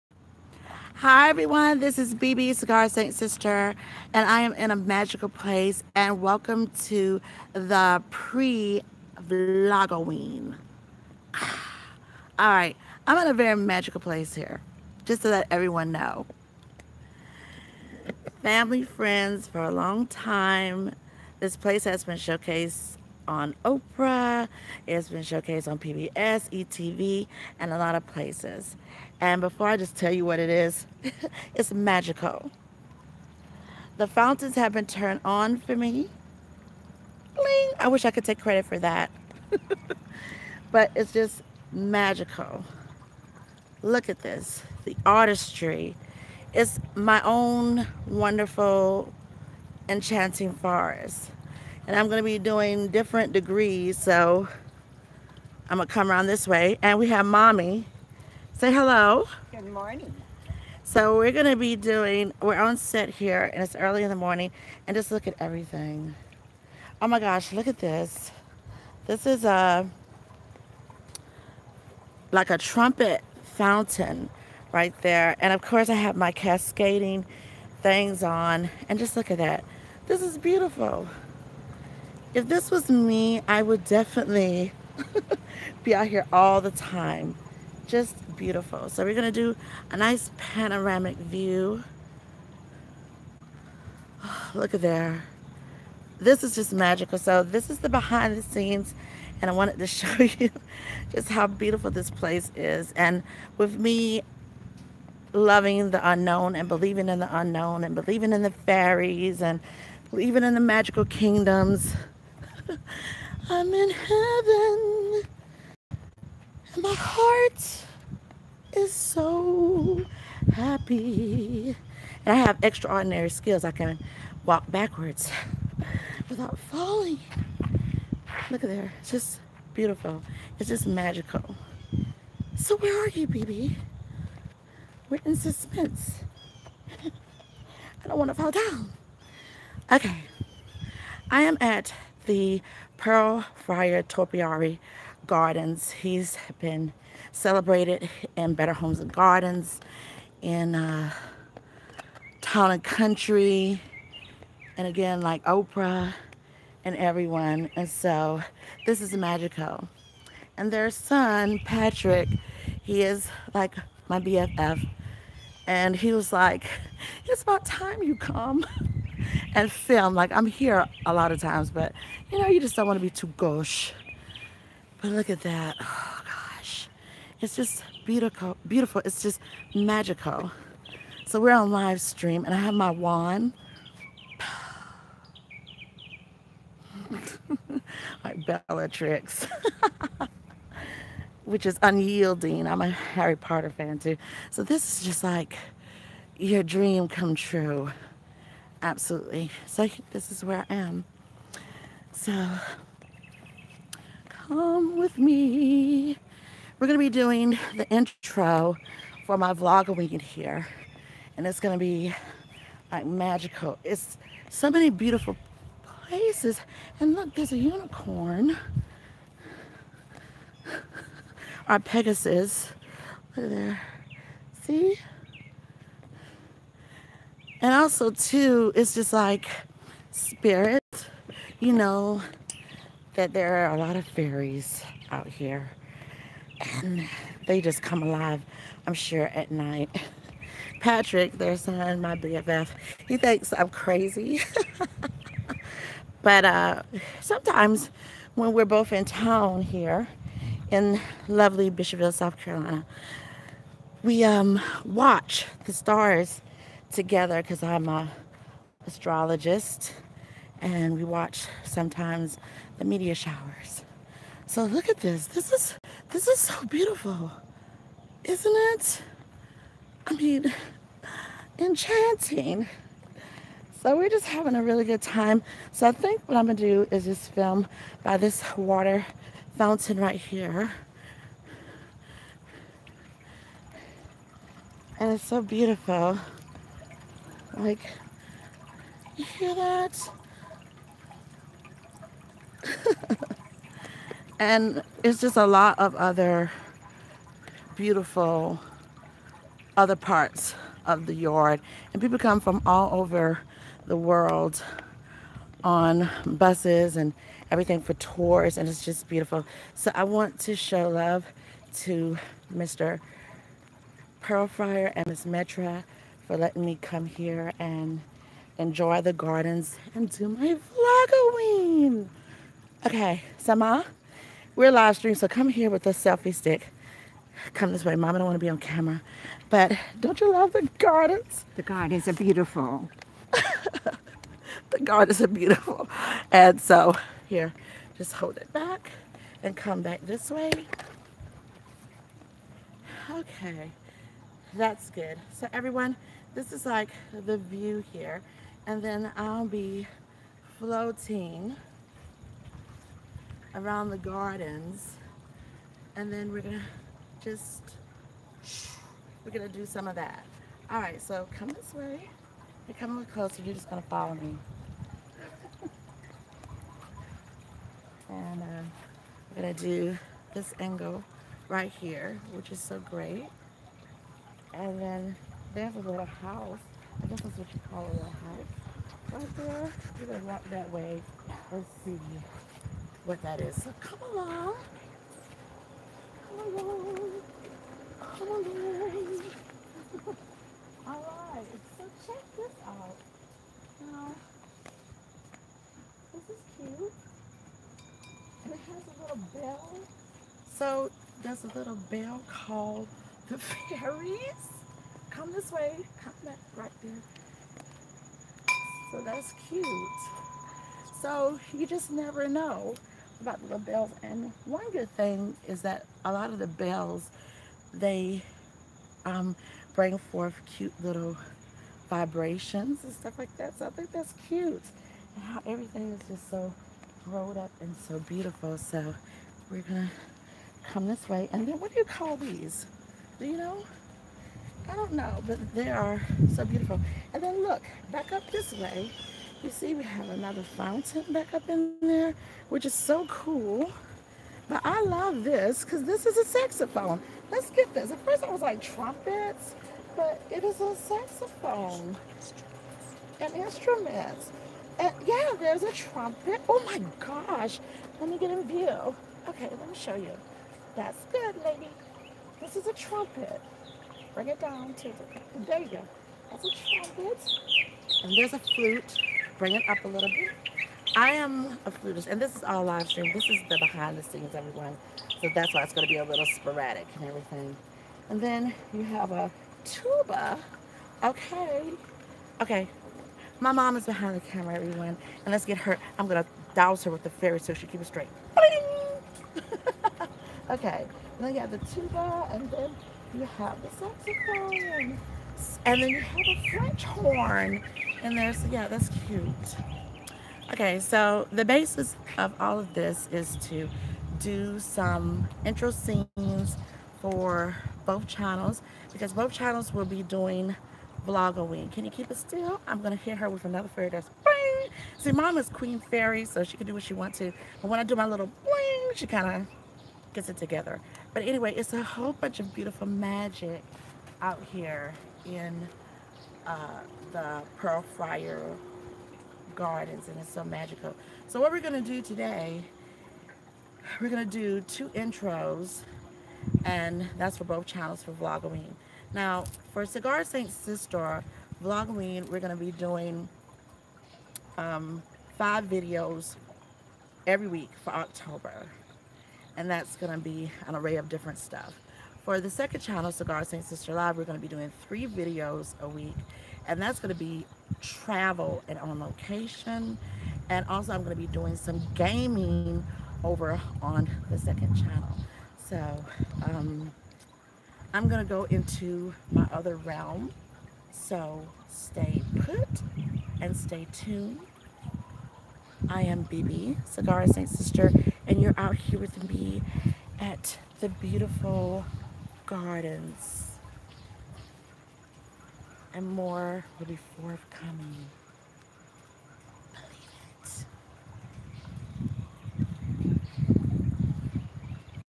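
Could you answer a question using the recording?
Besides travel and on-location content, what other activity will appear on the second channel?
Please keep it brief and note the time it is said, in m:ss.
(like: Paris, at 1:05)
gaming, at 9:21.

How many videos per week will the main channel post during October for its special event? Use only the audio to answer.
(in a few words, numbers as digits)
5.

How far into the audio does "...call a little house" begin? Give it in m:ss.
6:17.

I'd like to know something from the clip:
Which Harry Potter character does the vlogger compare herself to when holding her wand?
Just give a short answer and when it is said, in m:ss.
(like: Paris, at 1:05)
Bellatrix, at 3:08.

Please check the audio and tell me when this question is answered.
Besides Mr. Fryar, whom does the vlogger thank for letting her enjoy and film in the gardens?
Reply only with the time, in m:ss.
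5:15.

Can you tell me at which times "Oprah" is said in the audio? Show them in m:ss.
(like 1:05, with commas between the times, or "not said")
0:23, 2:35.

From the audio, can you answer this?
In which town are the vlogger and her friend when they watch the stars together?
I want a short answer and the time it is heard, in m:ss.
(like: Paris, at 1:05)
Bishopville, South Carolina, at 4:11.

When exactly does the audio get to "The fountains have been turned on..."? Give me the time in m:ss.
0:33.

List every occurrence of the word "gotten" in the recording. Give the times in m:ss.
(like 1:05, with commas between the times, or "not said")
not said.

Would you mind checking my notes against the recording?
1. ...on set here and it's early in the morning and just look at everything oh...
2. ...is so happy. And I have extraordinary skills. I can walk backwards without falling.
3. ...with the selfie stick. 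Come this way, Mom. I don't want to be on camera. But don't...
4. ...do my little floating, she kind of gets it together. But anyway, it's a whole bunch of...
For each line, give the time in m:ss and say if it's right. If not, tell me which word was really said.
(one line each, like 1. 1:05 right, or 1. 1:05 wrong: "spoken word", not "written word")
1. 1:02 right
2. 1:58 right
3. 5:25 right
4. 8:37 wrong: "bling", not "floating".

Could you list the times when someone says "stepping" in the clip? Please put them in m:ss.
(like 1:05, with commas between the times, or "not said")
not said.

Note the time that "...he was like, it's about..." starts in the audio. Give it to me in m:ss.
2:45.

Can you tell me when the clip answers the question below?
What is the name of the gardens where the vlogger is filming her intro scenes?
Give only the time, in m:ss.
2:22.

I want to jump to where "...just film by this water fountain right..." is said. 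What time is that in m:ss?
4:37.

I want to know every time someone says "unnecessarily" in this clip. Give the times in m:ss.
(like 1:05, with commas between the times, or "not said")
not said.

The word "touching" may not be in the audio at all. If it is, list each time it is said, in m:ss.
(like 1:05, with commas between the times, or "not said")
not said.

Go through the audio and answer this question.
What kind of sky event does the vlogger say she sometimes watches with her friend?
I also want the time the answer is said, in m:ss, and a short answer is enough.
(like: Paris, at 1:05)
meteor showers, at 4:22.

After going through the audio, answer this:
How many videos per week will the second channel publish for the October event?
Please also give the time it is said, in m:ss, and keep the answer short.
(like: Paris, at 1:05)
3, at 9:14.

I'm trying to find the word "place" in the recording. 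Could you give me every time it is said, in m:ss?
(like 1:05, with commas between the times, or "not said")
0:05, 0:13, 0:21, 0:28, 1:42, 3:35.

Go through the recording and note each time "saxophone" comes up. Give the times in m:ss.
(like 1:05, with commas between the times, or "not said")
7:26, 7:30, 8:13.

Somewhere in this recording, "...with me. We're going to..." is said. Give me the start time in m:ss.
3:24.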